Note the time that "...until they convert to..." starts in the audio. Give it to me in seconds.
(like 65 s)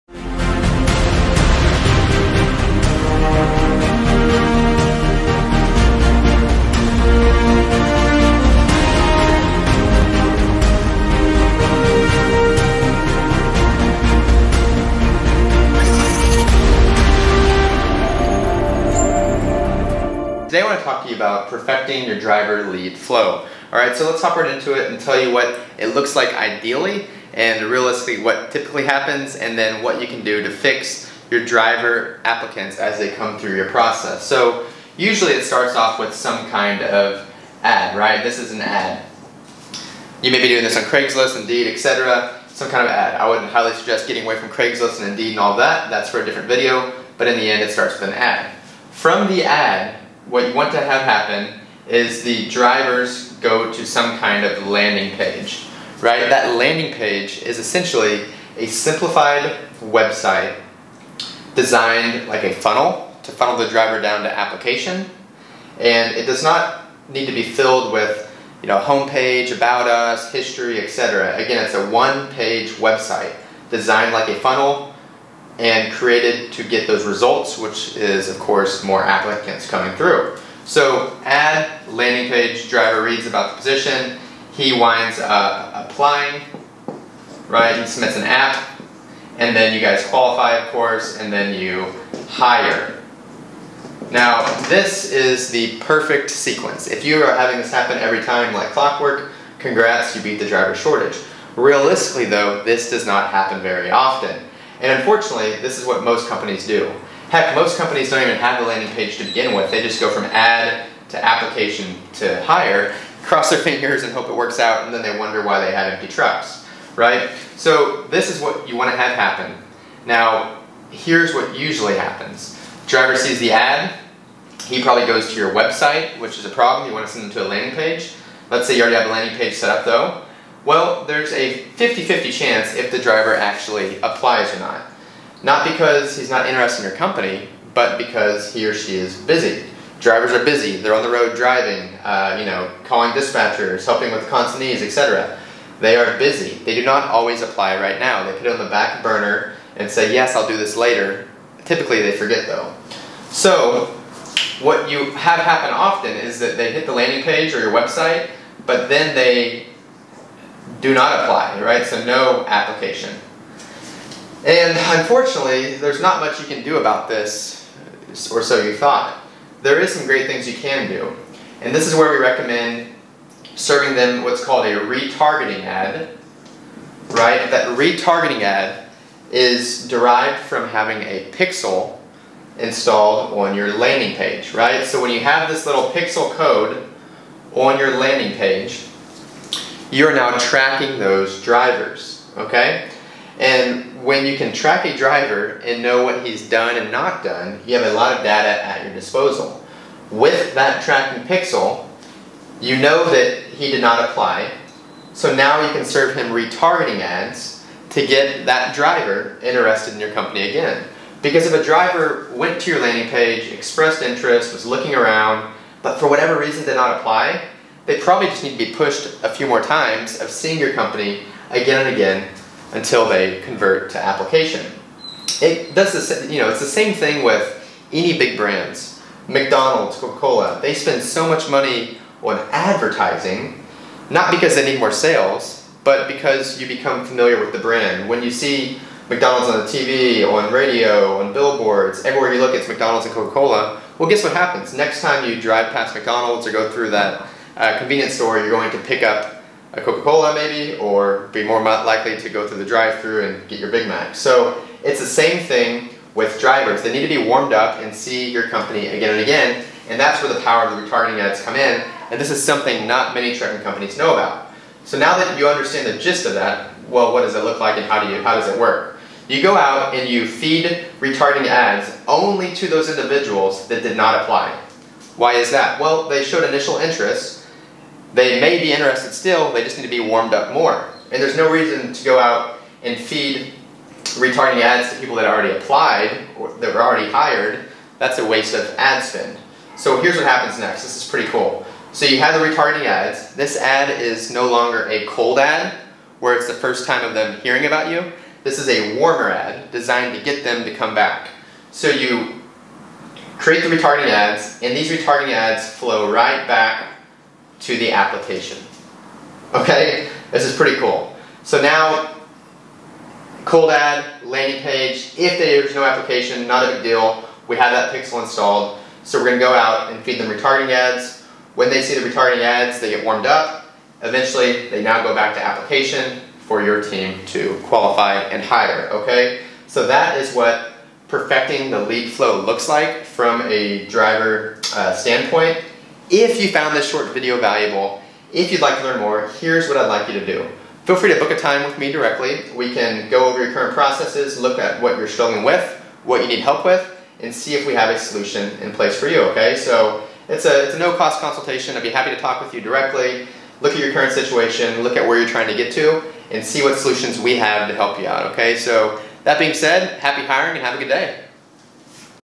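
222 s.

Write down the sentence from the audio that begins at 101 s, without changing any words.
Realistically, though, this does not happen very often.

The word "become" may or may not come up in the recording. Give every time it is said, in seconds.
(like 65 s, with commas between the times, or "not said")
236 s.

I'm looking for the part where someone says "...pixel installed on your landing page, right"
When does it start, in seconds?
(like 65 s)
181 s.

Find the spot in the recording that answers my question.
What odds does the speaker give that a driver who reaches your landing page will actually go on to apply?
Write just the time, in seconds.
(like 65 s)
131 s.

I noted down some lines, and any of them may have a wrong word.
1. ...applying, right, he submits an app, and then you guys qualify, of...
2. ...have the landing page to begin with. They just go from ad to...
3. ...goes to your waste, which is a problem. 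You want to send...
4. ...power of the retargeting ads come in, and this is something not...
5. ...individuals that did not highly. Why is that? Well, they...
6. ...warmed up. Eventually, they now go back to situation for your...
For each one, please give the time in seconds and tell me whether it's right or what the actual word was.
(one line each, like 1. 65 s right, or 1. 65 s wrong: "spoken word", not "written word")
1. 85 s right
2. 108 s right
3. 125 s wrong: "website", not "waste"
4. 260 s right
5. 272 s wrong: "apply", not "highly"
6. 323 s wrong: "application", not "situation".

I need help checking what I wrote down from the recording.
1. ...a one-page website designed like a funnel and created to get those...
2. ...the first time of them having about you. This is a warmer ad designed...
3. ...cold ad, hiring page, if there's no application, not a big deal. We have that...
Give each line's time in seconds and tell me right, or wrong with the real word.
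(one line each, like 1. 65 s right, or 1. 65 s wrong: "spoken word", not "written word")
1. 71 s right
2. 296 s wrong: "hearing", not "having"
3. 313 s wrong: "landing", not "hiring".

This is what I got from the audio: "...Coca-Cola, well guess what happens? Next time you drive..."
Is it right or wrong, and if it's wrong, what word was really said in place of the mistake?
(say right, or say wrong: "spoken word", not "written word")
right.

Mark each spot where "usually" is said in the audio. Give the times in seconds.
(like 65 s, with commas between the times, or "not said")
34 s, 121 s.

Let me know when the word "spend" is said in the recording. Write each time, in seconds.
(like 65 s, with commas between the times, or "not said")
230 s, 289 s.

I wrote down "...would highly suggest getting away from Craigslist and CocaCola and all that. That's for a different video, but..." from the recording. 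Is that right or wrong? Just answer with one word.
wrong.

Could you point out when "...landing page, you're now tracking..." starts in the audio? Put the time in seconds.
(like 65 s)
187 s.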